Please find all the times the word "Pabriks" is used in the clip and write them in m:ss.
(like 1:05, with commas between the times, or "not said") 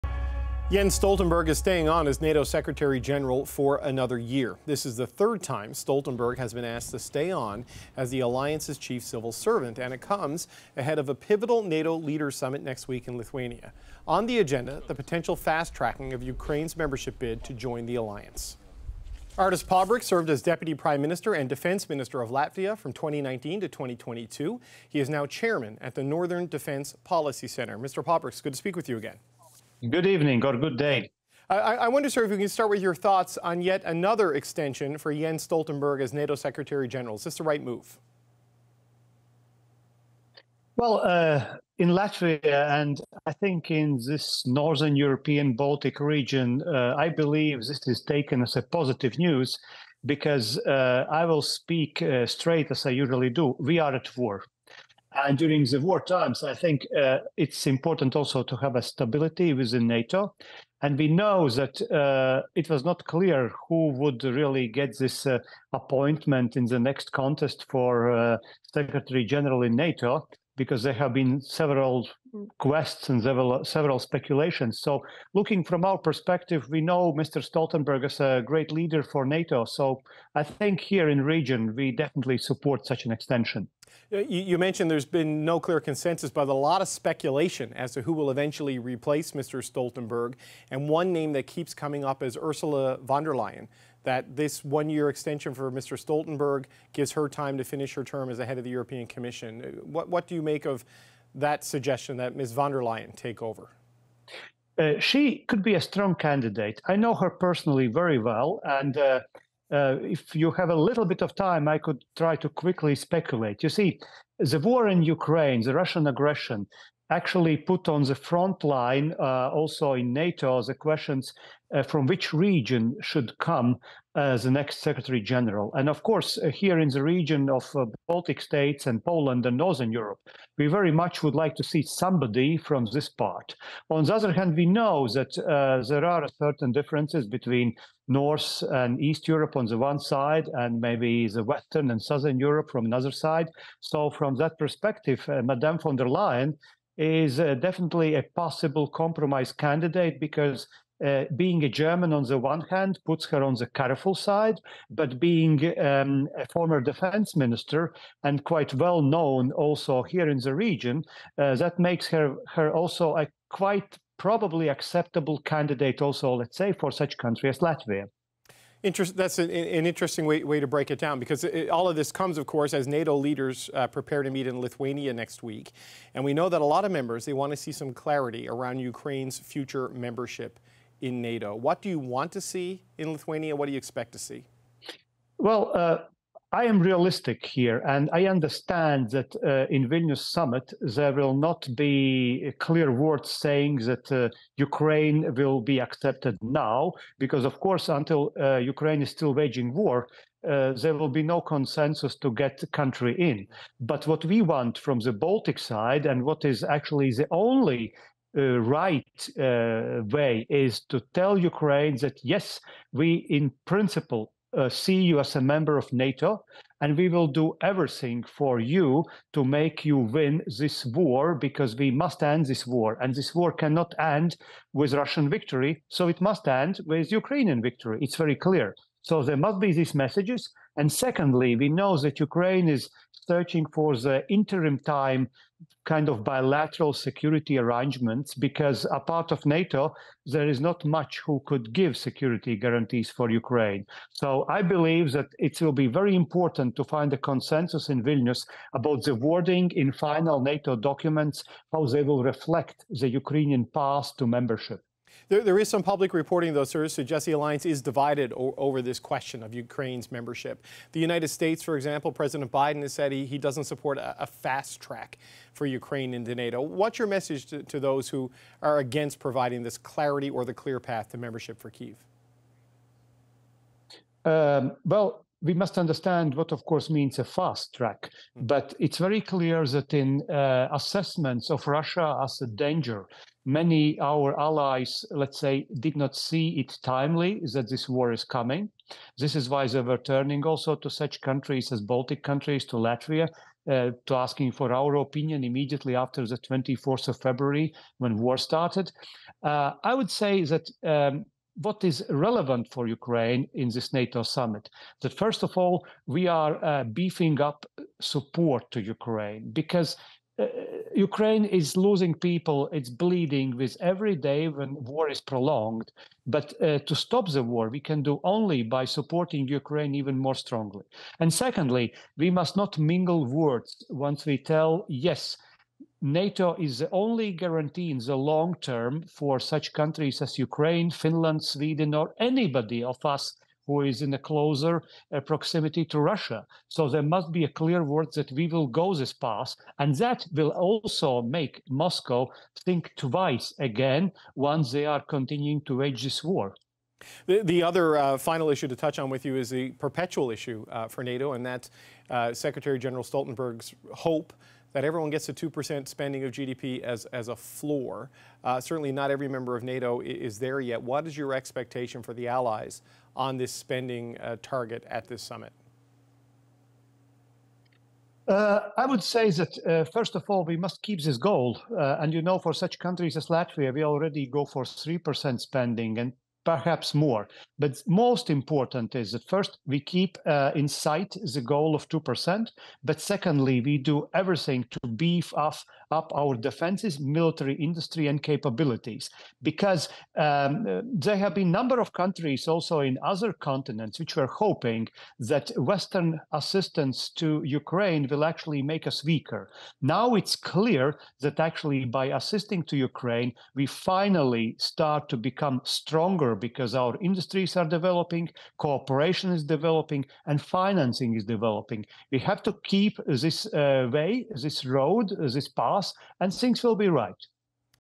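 0:19, 0:28.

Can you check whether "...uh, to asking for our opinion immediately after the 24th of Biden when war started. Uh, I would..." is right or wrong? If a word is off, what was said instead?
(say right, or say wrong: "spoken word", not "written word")
wrong: "February", not "Biden".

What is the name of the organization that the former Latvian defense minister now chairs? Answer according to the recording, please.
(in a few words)
Northern Defense Policy Center.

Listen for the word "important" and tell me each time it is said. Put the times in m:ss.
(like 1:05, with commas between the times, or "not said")
0:57, 4:06, 6:18.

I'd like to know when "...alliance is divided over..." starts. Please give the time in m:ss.
4:17.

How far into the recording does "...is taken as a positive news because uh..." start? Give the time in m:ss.
0:47.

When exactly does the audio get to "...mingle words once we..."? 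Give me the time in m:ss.
5:22.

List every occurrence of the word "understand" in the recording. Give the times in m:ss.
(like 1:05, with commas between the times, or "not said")
3:08, 4:35.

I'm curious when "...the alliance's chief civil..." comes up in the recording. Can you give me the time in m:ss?
0:08.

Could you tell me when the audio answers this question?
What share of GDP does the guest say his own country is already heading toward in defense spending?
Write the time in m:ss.
6:14.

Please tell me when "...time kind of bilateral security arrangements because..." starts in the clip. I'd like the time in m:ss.
3:54.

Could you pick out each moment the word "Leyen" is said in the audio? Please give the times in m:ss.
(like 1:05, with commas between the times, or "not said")
1:33, 1:42, 2:26.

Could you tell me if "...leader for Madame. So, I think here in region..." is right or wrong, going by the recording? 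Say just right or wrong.
wrong.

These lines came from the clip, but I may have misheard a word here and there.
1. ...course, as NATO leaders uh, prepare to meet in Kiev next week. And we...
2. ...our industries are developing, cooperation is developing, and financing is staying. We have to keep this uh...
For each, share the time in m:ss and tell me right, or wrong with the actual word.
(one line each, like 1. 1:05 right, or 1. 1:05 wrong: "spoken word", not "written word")
1. 2:52 wrong: "Lithuania", not "Kiev"
2. 6:46 wrong: "developing", not "staying".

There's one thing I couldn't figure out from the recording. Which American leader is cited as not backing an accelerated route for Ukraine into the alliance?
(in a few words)
President Biden.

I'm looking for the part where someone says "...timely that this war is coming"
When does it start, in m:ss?
4:46.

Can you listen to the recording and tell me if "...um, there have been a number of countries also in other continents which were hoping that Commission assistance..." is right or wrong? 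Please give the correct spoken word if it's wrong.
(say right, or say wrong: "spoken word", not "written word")
wrong: "Western", not "Commission".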